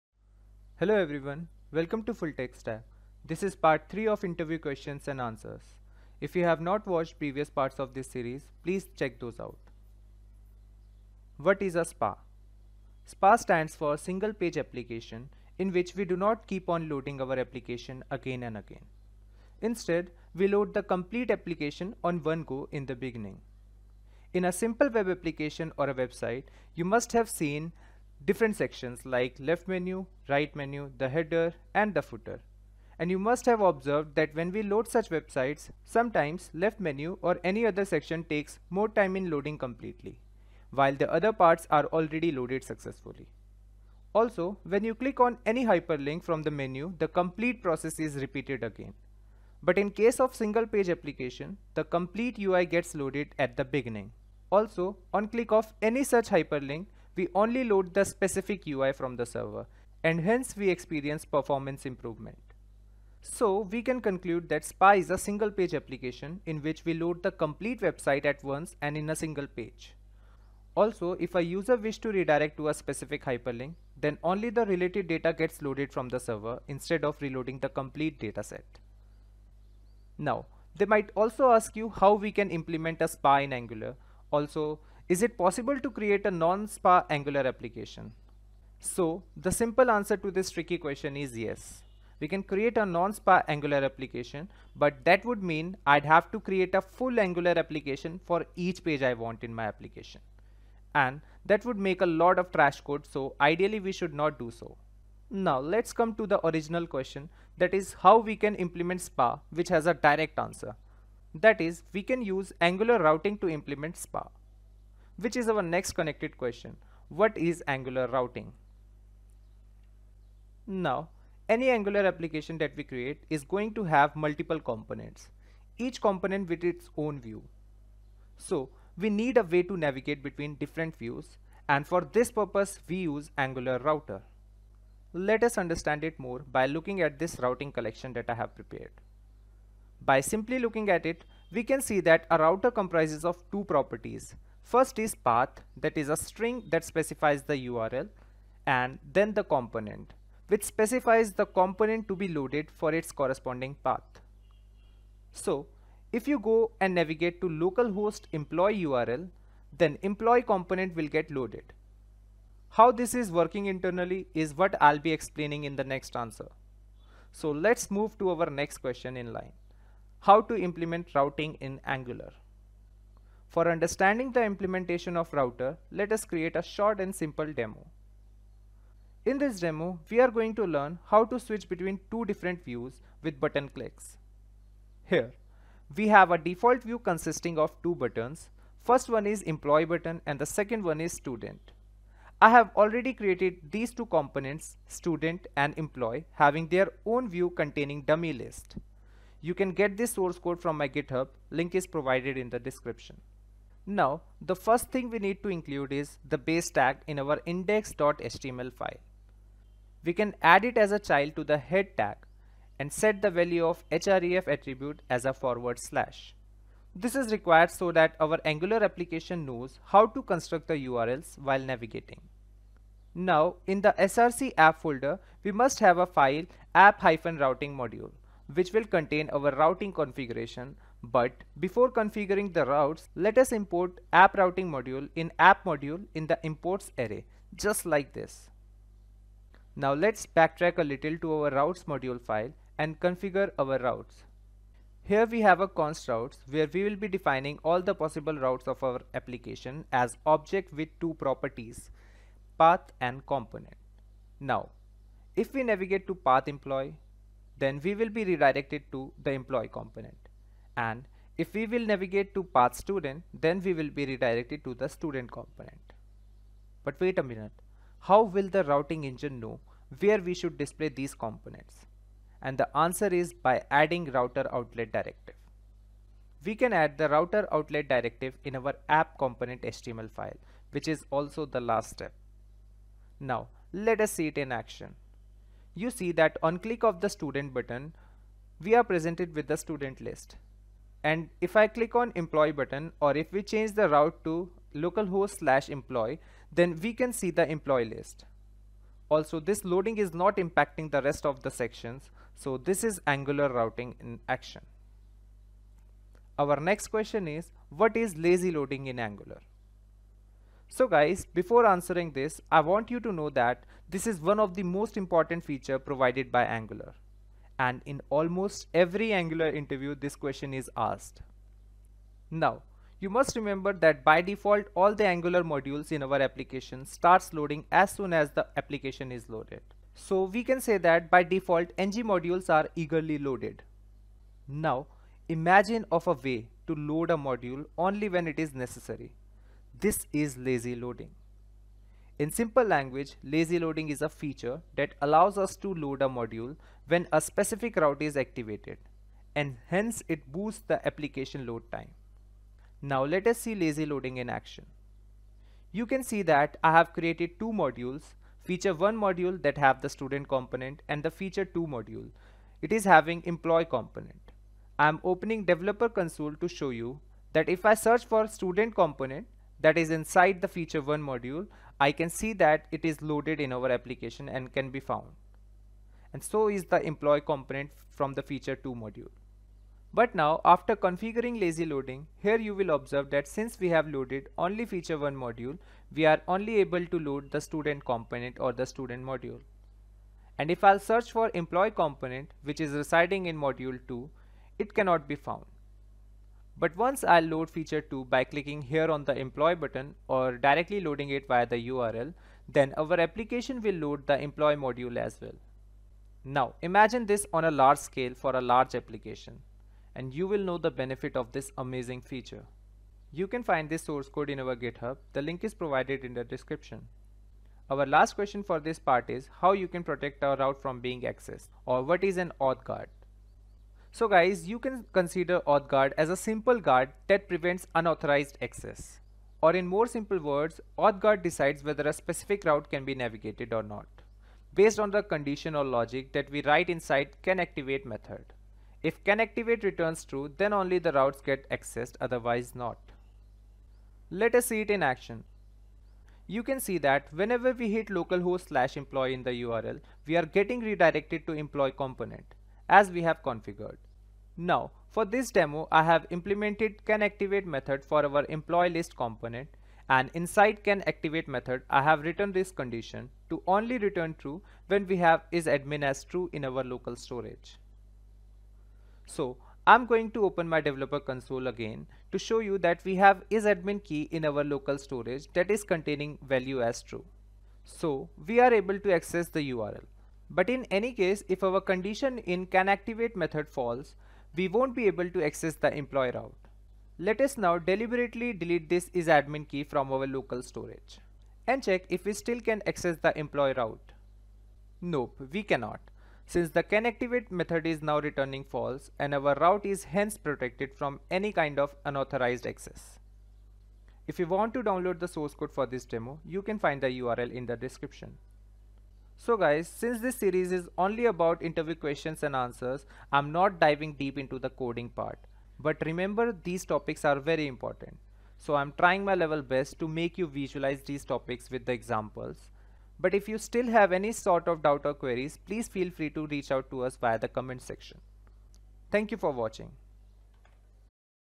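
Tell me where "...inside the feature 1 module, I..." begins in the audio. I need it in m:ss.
6:10.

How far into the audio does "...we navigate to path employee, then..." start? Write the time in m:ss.
4:15.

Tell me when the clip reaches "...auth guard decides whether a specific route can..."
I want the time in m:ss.
7:10.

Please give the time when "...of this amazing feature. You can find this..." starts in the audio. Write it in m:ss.
6:51.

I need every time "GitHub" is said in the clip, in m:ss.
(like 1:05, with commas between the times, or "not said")
3:20, 6:54.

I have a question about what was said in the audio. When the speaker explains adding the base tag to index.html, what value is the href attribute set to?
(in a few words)
forward slash.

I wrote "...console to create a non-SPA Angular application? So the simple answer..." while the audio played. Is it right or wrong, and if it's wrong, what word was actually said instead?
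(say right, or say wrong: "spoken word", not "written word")
wrong: "possible", not "console".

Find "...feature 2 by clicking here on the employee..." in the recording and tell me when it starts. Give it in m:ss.
6:37.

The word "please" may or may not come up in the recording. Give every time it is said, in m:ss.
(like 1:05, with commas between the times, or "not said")
0:08, 8:45.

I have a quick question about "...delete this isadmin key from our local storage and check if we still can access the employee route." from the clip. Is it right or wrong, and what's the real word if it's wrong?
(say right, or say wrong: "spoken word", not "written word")
right.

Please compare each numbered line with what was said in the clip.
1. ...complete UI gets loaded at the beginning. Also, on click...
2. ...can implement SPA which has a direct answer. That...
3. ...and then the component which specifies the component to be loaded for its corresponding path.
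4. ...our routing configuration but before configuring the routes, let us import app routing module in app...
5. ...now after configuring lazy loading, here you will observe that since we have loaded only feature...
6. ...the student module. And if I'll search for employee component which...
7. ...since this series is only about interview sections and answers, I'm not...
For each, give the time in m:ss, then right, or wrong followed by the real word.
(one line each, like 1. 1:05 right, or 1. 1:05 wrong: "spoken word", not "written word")
1. 0:51 right
2. 1:48 right
3. 2:28 right
4. 3:49 right
5. 6:20 right
6. 6:28 right
7. 8:29 wrong: "questions", not "sections".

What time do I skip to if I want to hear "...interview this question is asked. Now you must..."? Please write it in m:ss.
5:19.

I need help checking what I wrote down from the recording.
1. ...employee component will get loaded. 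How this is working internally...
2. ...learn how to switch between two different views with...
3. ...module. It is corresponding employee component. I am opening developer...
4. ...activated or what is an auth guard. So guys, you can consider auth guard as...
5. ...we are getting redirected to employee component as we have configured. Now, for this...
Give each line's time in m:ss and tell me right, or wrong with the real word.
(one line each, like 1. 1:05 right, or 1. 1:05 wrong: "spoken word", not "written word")
1. 2:40 right
2. 3:00 right
3. 6:01 wrong: "having", not "corresponding"
4. 7:01 wrong: "accessed", not "activated"
5. 7:30 right.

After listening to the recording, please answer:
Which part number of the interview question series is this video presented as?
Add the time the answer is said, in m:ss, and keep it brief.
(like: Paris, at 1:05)
3, at 0:03.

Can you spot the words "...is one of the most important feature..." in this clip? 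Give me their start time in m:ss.
5:14.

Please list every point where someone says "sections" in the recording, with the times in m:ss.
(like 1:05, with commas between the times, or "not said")
0:28, 0:37, 5:01, 8:47.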